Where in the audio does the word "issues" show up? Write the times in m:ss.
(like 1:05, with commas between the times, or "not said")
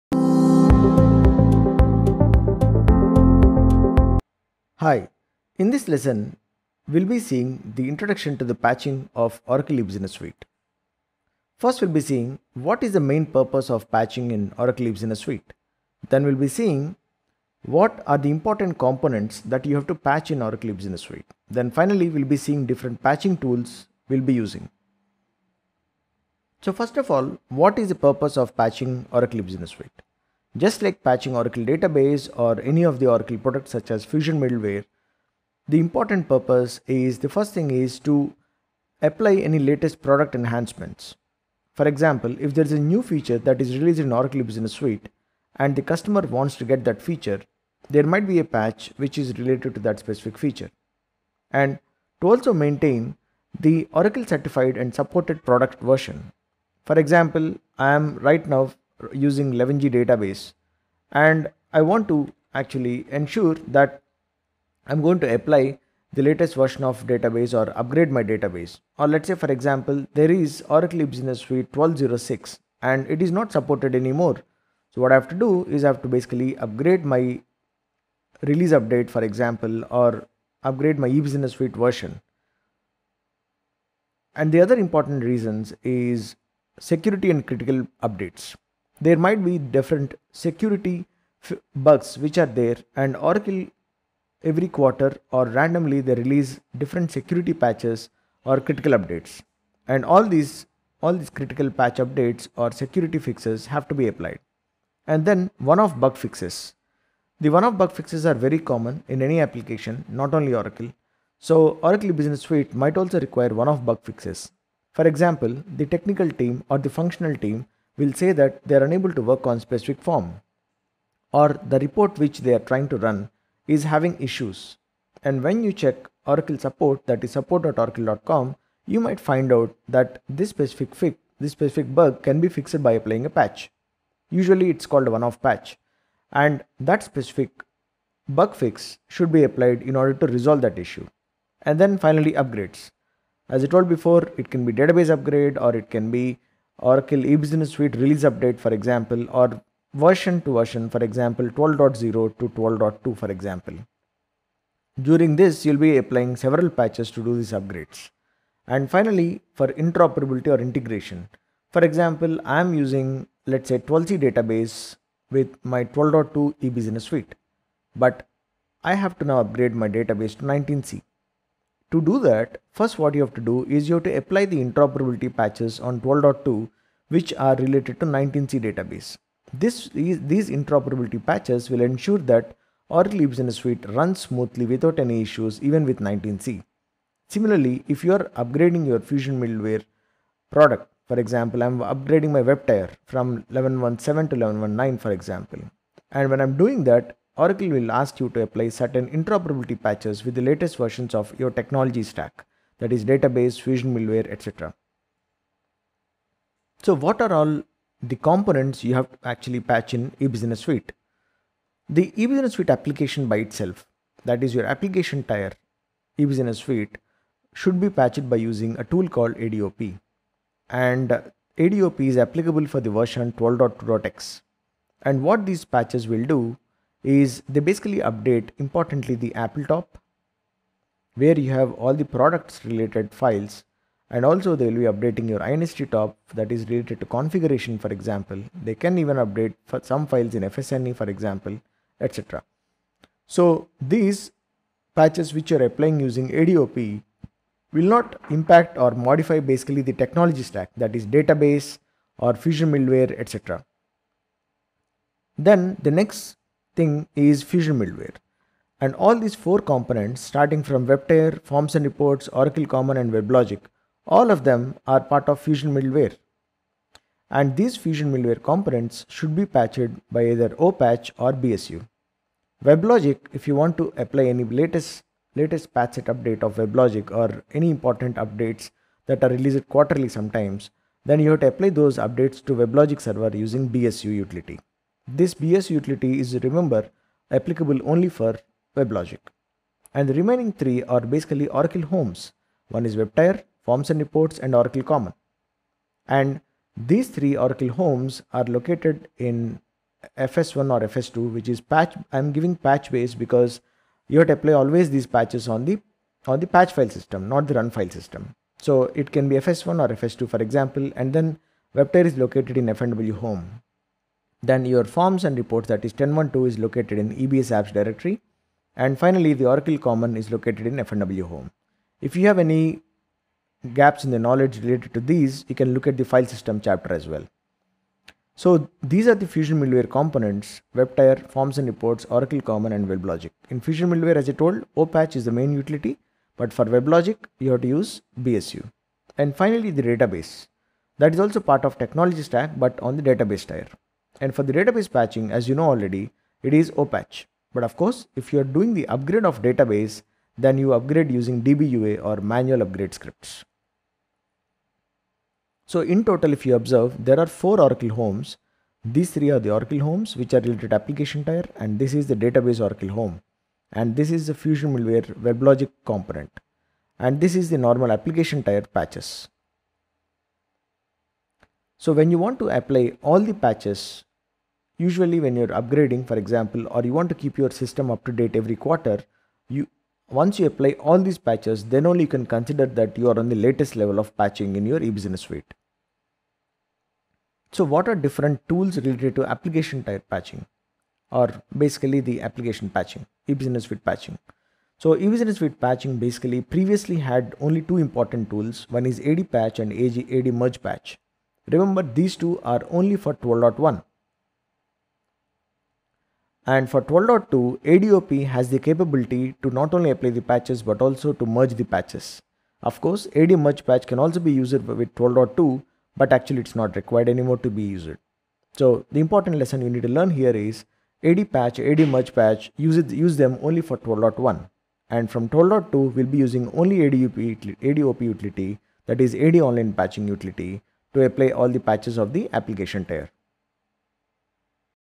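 2:04, 2:20, 3:05.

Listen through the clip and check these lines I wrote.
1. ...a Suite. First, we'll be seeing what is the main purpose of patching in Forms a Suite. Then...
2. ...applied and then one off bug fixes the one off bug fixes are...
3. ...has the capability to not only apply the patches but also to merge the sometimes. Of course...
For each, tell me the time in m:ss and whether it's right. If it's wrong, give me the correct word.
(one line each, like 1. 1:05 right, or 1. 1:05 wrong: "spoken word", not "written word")
1. 0:09 wrong: "Oracle", not "Forms"
2. 1:44 right
3. 6:48 wrong: "patches", not "sometimes".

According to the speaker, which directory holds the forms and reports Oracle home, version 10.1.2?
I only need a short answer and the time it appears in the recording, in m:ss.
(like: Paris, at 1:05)
EBS apps, at 5:17.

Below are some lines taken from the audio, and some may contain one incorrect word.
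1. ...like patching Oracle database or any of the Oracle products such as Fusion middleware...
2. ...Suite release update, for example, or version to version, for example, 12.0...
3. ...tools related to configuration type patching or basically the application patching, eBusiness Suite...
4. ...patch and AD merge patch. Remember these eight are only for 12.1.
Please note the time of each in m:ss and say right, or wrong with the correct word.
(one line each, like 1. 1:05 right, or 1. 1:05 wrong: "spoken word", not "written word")
1. 0:30 right
2. 2:27 right
3. 6:28 wrong: "application", not "configuration"
4. 6:39 wrong: "two", not "eight".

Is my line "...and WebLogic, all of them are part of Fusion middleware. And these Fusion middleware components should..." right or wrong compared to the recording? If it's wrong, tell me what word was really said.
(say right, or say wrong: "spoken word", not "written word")
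right.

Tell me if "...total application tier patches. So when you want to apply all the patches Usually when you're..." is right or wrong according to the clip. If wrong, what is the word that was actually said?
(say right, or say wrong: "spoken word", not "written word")
wrong: "normal", not "total".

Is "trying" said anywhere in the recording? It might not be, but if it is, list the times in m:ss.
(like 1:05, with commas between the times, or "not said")
2:02.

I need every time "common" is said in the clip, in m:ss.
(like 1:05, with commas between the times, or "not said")
1:48, 4:22, 4:54, 5:19, 5:32.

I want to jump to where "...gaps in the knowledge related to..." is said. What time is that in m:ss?
5:23.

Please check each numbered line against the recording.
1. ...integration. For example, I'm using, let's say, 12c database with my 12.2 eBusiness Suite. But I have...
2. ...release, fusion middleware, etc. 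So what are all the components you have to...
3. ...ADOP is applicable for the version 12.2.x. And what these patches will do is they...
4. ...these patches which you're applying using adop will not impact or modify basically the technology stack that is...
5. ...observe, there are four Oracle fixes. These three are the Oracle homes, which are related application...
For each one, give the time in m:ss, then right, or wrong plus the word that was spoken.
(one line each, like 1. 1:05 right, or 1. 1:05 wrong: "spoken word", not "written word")
1. 2:40 right
2. 3:23 wrong: "database", not "release"
3. 3:41 right
4. 4:03 right
5. 5:56 wrong: "homes", not "fixes".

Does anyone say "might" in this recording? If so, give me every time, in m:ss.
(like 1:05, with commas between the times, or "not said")
0:48, 1:29, 1:52, 2:09.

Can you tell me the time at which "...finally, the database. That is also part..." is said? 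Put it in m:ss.
5:39.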